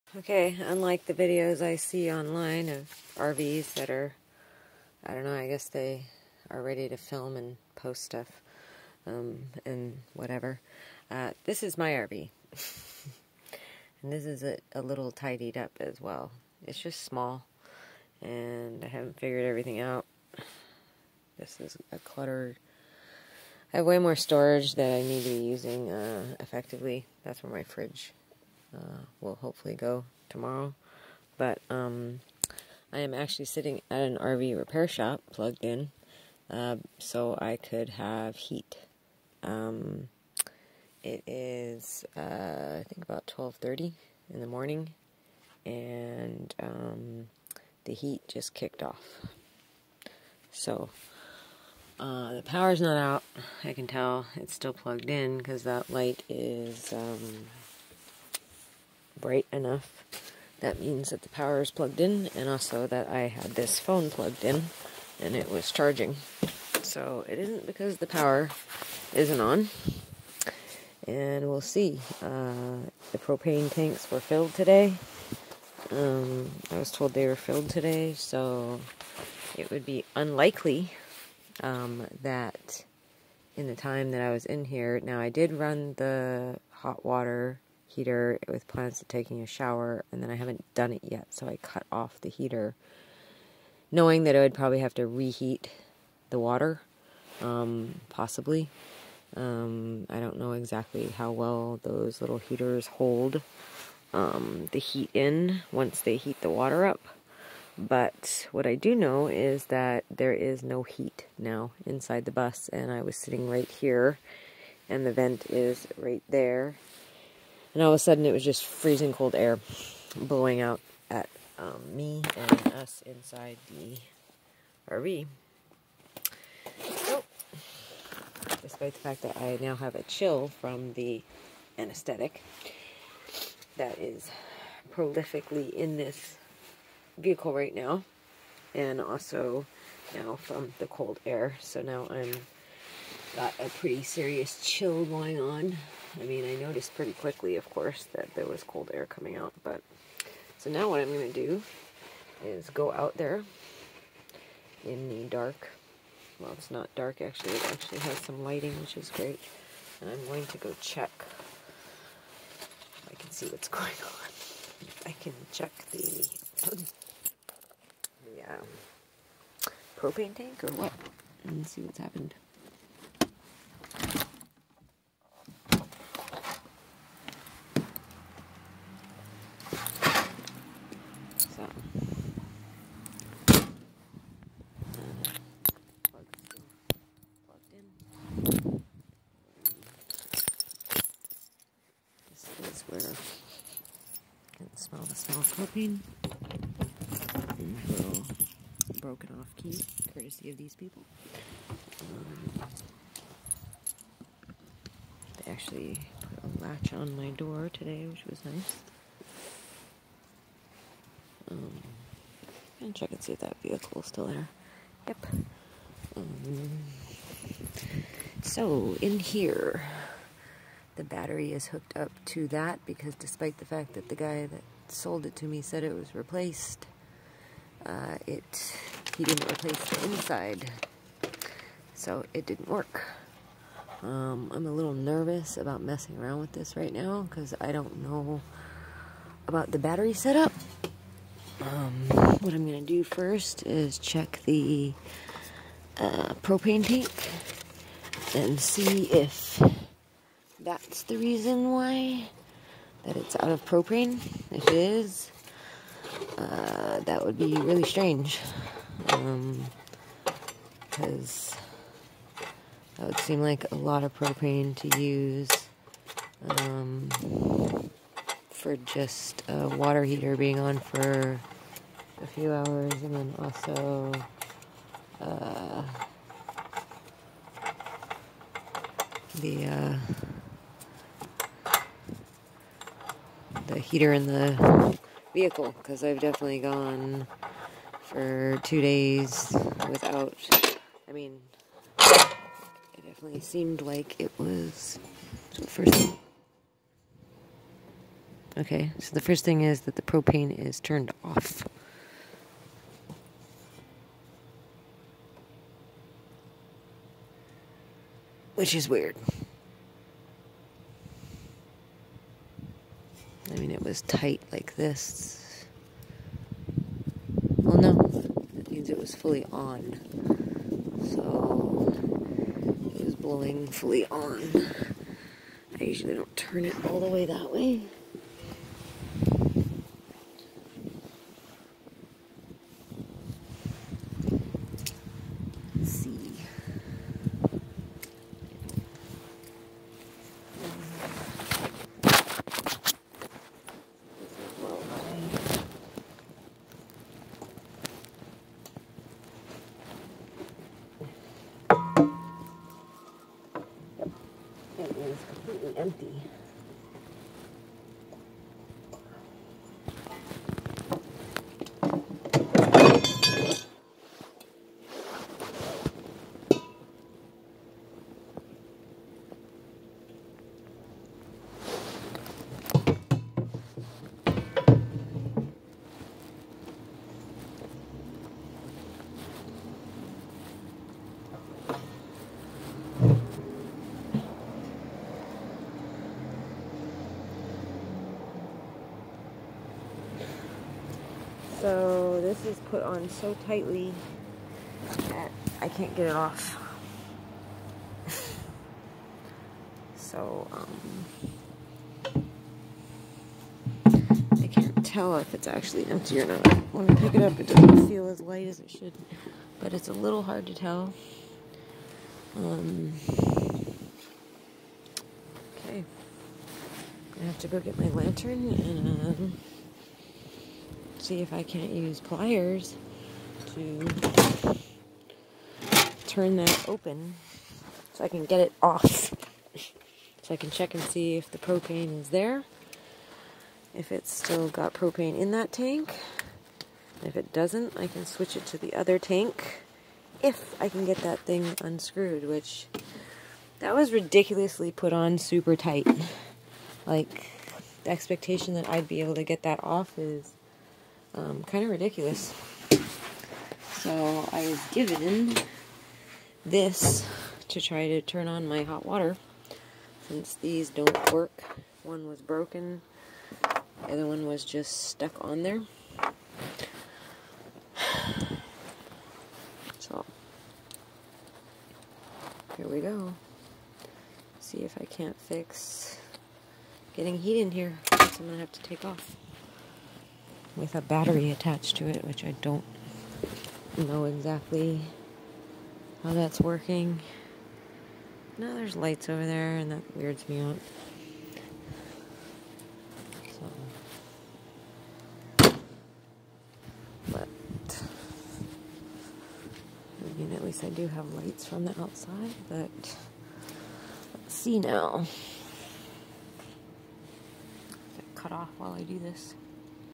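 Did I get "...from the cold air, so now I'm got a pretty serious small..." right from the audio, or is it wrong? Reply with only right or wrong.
wrong.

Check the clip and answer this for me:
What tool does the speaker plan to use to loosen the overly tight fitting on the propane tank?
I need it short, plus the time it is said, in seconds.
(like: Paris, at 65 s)
pliers, at 421 s.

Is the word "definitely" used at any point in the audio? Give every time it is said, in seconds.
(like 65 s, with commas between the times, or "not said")
286 s, 293 s.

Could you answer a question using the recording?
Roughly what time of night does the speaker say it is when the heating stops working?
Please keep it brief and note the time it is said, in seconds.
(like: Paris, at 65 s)
12:30, at 43 s.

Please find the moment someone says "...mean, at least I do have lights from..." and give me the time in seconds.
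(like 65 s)
500 s.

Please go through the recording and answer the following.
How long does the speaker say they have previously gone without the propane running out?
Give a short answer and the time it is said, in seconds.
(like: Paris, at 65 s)
two days, at 288 s.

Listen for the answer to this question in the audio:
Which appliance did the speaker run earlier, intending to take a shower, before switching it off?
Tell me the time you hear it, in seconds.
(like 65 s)
86 s.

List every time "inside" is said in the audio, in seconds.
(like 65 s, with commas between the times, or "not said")
111 s, 123 s, 230 s.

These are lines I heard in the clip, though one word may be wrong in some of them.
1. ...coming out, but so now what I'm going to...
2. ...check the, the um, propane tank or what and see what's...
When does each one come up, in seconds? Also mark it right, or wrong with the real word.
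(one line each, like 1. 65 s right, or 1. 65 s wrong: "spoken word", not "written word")
1. 149 s right
2. 165 s right.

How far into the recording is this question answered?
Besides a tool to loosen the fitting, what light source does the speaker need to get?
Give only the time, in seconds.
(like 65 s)
417 s.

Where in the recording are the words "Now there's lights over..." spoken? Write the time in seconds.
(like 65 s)
488 s.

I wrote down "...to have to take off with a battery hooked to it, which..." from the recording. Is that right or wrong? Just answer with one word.
wrong.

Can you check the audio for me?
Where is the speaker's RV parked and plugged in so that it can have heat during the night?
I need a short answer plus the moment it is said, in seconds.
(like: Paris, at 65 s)
RV repair shop, at 34 s.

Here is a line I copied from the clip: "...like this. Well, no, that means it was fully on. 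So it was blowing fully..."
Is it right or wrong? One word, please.
right.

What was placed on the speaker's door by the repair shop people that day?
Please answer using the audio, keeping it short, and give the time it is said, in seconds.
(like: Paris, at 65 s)
a latch, at 206 s.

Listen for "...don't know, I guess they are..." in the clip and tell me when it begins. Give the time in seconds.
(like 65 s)
5 s.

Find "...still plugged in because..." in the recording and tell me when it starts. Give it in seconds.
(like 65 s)
54 s.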